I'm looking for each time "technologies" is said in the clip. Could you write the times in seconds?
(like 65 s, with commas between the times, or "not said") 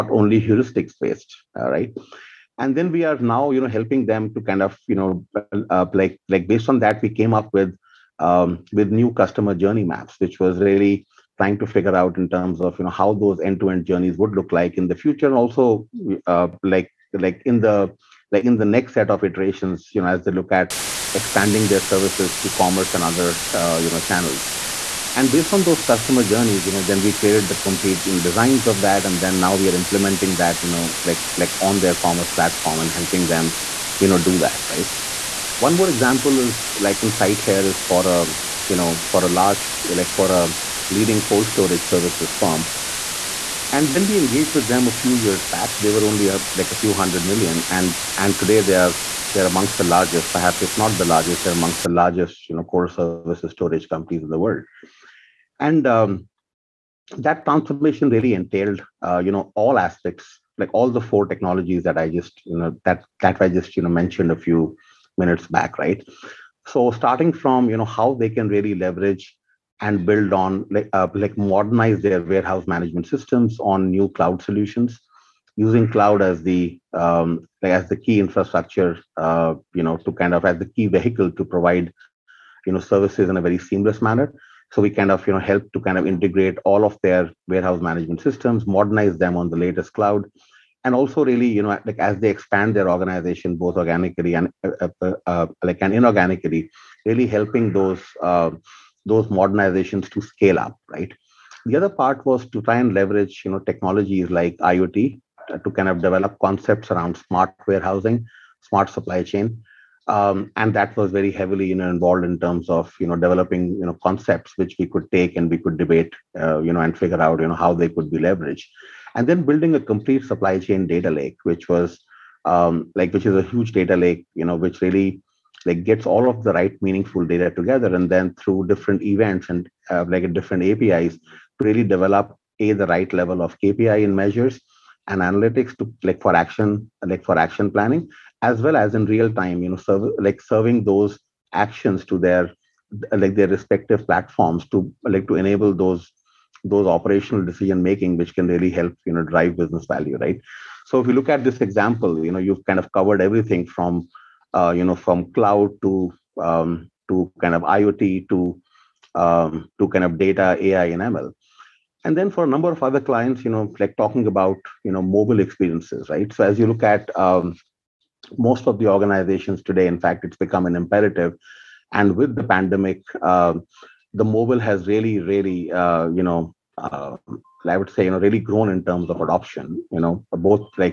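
61 s, 103 s.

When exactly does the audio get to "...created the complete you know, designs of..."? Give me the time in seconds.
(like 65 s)
27 s.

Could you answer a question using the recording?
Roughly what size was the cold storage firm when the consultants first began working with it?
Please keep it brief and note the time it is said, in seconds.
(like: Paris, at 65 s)
a few hundred million, at 46 s.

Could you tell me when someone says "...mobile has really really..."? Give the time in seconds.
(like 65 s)
174 s.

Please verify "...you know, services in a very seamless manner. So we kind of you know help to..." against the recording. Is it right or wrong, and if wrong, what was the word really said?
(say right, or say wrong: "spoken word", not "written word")
right.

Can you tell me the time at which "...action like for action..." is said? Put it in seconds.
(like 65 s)
136 s.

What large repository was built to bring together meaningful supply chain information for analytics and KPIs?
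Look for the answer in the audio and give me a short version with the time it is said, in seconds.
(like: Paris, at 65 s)
supply chain data lake, at 120 s.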